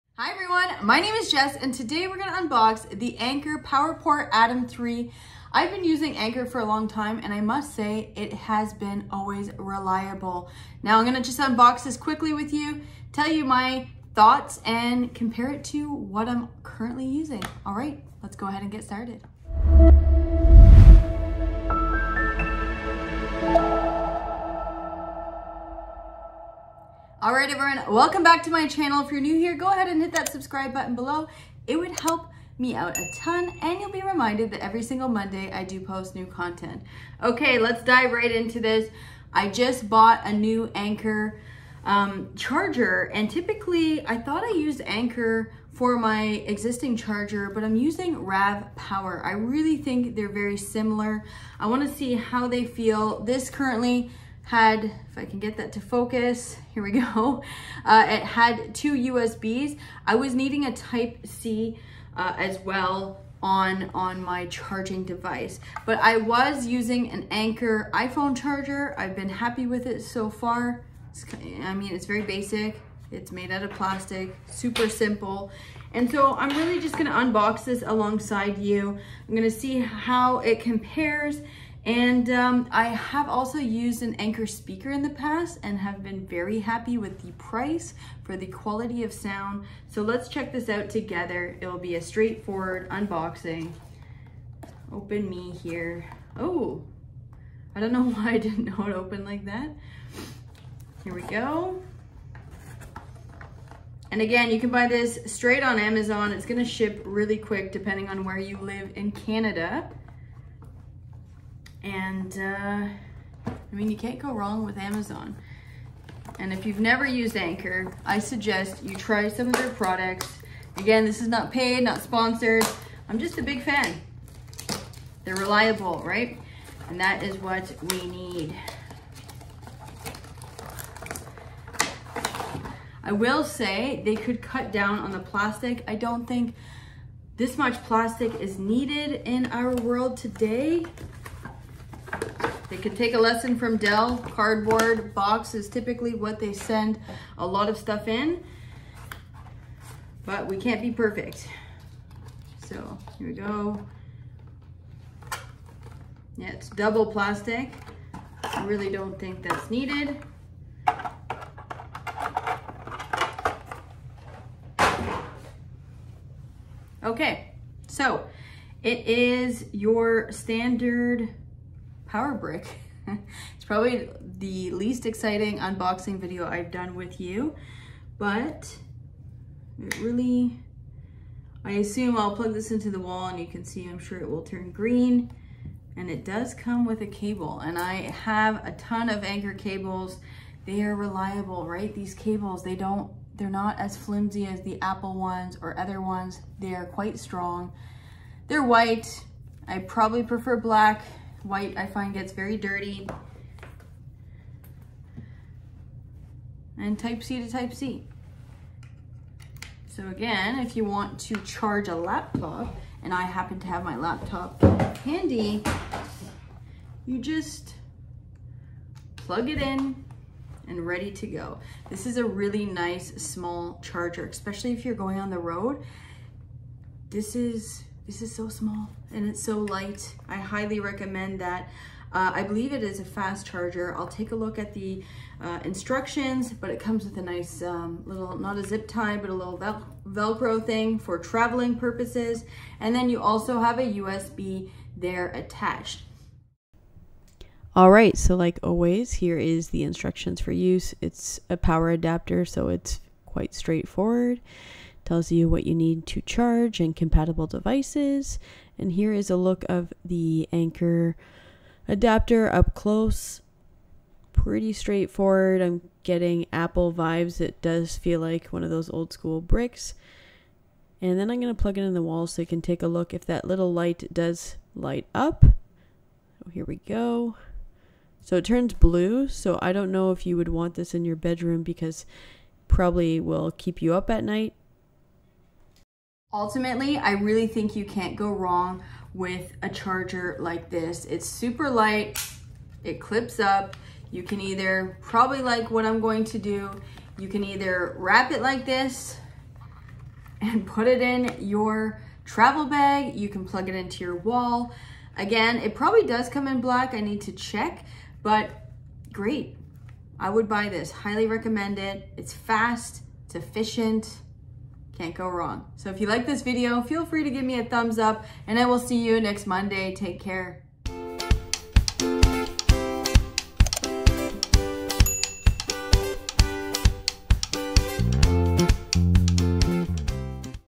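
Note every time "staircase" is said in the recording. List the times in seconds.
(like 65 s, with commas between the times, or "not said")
not said.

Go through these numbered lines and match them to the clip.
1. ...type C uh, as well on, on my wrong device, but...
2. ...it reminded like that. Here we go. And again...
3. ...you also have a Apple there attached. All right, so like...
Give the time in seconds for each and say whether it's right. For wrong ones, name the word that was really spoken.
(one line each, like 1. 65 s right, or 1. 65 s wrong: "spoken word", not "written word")
1. 60 s wrong: "charging", not "wrong"
2. 98 s wrong: "opened", not "reminded"
3. 243 s wrong: "USB", not "Apple".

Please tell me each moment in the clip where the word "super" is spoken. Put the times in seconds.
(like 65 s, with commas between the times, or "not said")
74 s, 291 s.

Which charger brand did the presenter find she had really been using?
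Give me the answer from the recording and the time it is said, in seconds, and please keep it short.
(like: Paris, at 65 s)
RAVPower, at 48 s.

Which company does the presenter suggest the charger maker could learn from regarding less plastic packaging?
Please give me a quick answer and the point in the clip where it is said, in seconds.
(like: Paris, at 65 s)
Dell, at 143 s.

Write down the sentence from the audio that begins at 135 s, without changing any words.
I don't think this much plastic is needed in our world today.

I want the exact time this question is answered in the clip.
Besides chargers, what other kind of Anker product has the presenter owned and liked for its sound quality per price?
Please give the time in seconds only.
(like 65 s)
84 s.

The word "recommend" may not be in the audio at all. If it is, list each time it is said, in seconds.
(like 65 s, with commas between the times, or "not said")
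230 s, 311 s.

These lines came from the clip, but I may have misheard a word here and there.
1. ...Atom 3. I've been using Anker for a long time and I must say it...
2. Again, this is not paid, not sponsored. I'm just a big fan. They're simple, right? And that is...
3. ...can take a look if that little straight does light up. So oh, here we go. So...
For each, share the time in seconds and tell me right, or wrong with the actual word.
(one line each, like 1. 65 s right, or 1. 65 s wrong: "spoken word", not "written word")
1. 4 s right
2. 120 s wrong: "reliable", not "simple"
3. 272 s wrong: "light", not "straight".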